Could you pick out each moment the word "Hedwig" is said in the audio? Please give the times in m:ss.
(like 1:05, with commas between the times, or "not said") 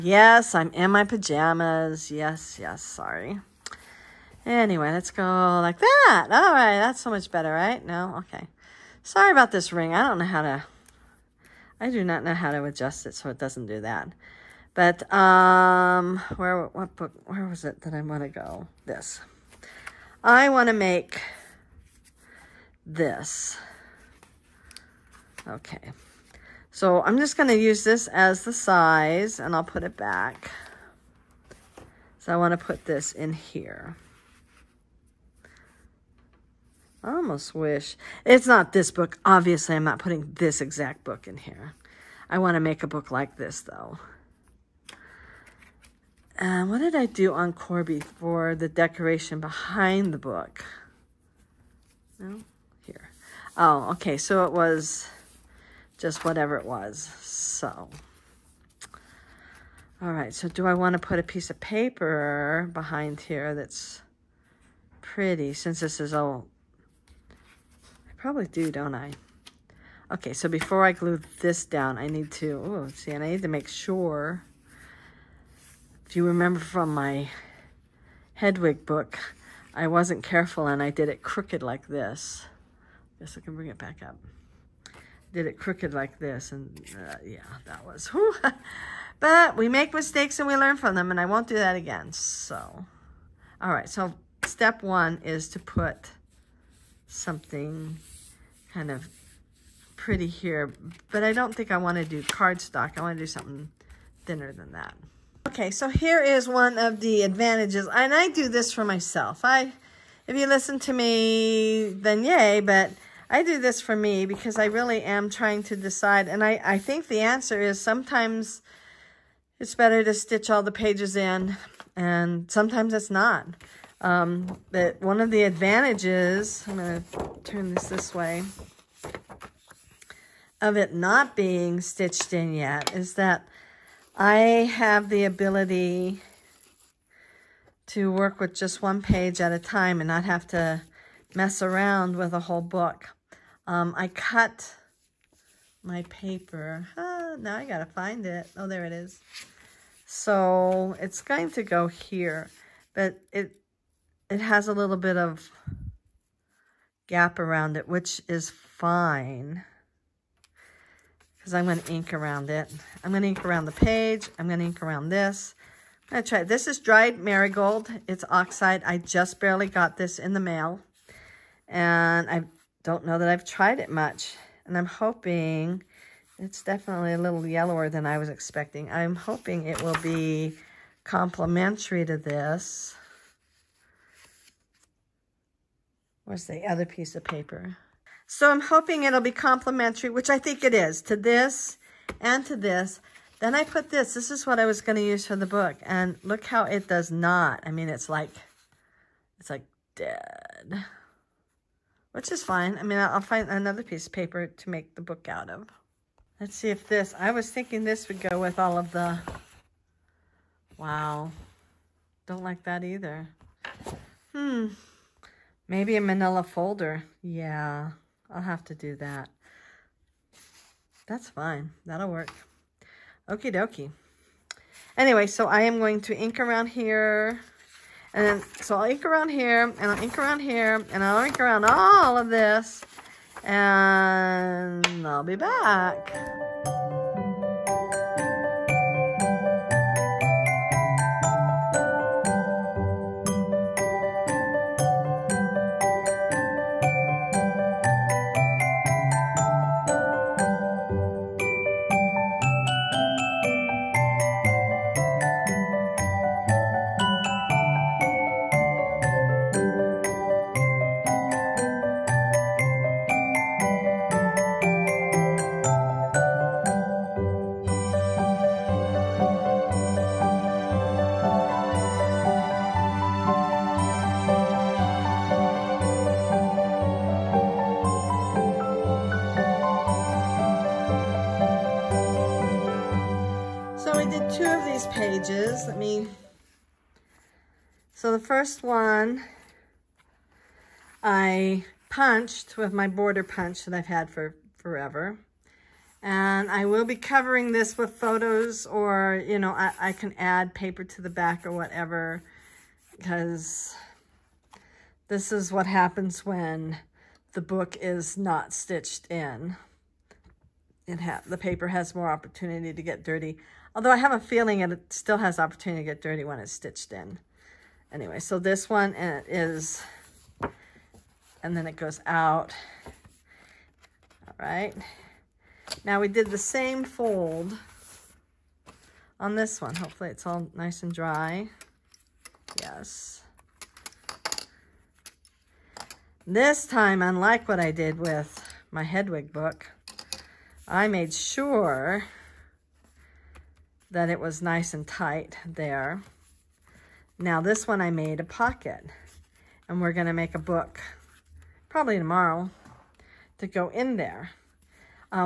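1:18, 5:38.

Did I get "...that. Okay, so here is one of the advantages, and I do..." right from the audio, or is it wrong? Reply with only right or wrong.
right.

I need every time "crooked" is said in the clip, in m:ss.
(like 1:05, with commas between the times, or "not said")
1:21, 1:25.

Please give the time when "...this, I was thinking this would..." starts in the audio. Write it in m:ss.
3:26.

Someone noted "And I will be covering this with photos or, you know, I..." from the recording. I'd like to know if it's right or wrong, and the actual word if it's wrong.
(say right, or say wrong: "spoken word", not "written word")
right.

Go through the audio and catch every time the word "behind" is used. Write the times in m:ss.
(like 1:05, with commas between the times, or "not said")
0:49, 1:02.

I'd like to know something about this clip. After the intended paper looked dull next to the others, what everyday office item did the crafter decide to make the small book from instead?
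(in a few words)
Manila folder.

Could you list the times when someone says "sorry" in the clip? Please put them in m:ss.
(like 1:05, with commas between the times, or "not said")
0:02, 0:09.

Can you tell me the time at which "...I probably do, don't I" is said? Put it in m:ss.
1:07.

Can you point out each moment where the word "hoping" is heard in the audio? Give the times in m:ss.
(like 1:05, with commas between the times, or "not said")
2:54, 2:59, 3:08.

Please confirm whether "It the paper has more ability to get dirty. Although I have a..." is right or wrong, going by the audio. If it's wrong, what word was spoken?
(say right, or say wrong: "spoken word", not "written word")
wrong: "opportunity", not "ability".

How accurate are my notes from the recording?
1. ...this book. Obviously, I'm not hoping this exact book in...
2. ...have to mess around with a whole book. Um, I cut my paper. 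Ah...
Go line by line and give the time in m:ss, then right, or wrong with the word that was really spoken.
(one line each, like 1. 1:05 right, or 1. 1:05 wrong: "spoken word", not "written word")
1. 0:38 wrong: "putting", not "hoping"
2. 2:20 right.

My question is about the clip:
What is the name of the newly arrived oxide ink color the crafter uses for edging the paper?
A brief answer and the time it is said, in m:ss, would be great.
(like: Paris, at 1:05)
Dried marigold, at 2:46.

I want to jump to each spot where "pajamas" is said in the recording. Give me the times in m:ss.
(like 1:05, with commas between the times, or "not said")
0:01.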